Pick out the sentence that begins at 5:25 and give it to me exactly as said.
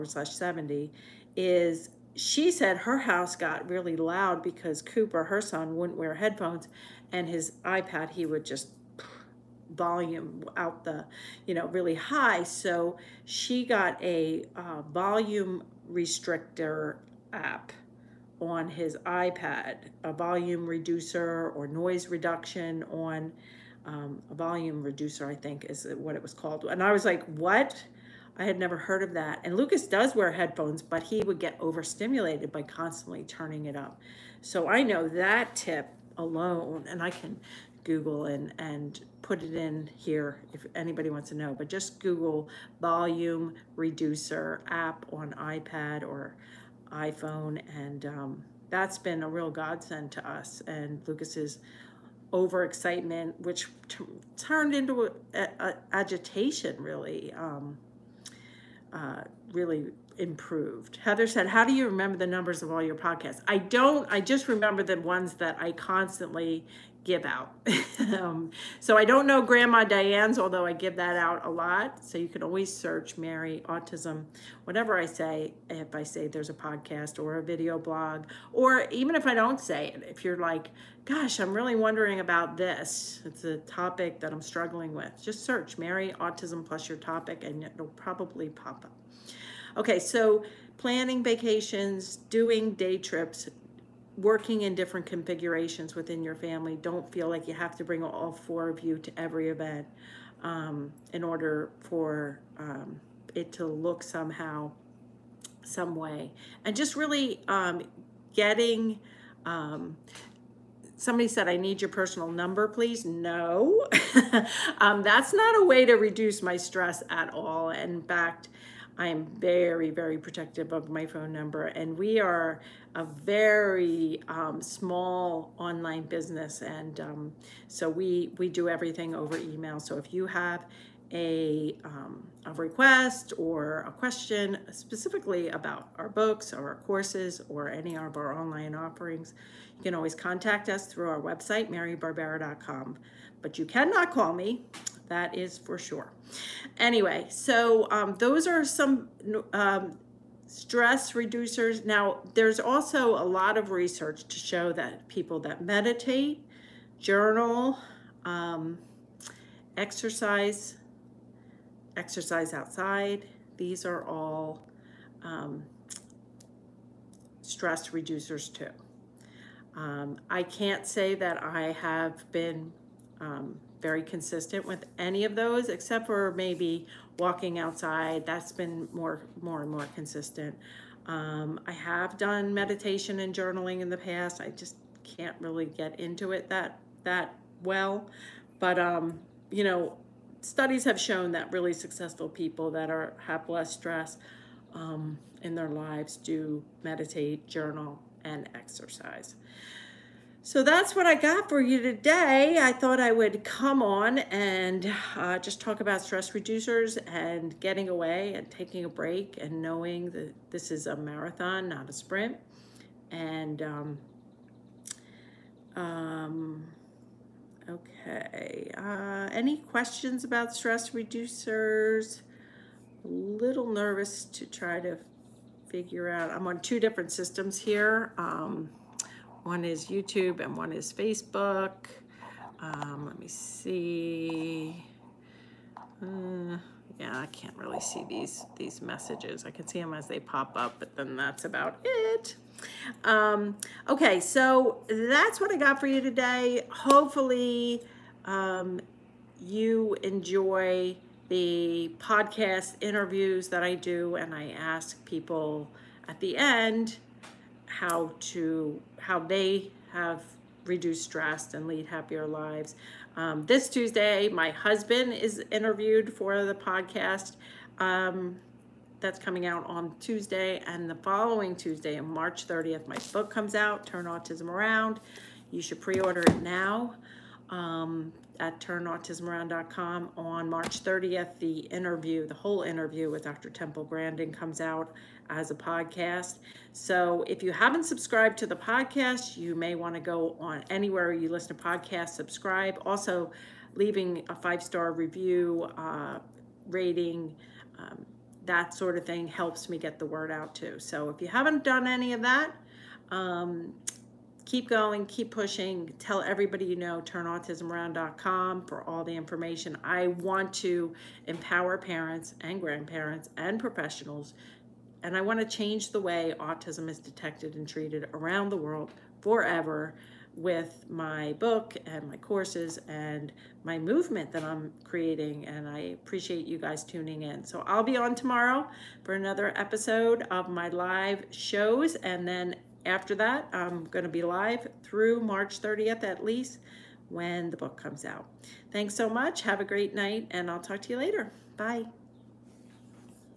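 And I appreciate you guys tuning in.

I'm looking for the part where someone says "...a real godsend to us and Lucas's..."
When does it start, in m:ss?
0:49.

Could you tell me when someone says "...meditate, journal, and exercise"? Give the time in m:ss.
3:16.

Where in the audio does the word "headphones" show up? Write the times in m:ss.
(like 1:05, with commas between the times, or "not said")
0:06, 0:30.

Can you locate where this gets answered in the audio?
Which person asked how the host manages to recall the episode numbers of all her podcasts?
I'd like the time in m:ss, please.
1:01.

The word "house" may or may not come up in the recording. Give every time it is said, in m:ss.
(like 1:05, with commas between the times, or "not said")
0:02.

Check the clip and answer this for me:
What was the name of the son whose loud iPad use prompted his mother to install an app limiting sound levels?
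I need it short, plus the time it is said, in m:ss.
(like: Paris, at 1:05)
Cooper, at 0:04.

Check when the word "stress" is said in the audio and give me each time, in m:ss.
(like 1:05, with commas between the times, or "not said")
1:56, 2:30, 2:47, 3:13, 3:26, 3:40, 4:21.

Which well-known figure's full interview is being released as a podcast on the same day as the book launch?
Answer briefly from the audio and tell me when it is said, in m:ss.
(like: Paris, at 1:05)
Dr. Temple Grandin, at 4:43.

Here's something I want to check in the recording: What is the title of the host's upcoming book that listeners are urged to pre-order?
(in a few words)
Turn Autism Around.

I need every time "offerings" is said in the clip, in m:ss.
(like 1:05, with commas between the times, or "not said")
2:18.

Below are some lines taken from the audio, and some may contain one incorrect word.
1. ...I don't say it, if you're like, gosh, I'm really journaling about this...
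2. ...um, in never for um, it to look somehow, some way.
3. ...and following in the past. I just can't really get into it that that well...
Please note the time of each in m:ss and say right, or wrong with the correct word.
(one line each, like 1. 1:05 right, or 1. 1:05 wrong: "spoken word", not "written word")
1. 1:19 wrong: "wondering", not "journaling"
2. 1:40 wrong: "order", not "never"
3. 3:03 wrong: "journaling", not "following".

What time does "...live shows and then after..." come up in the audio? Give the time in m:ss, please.
5:30.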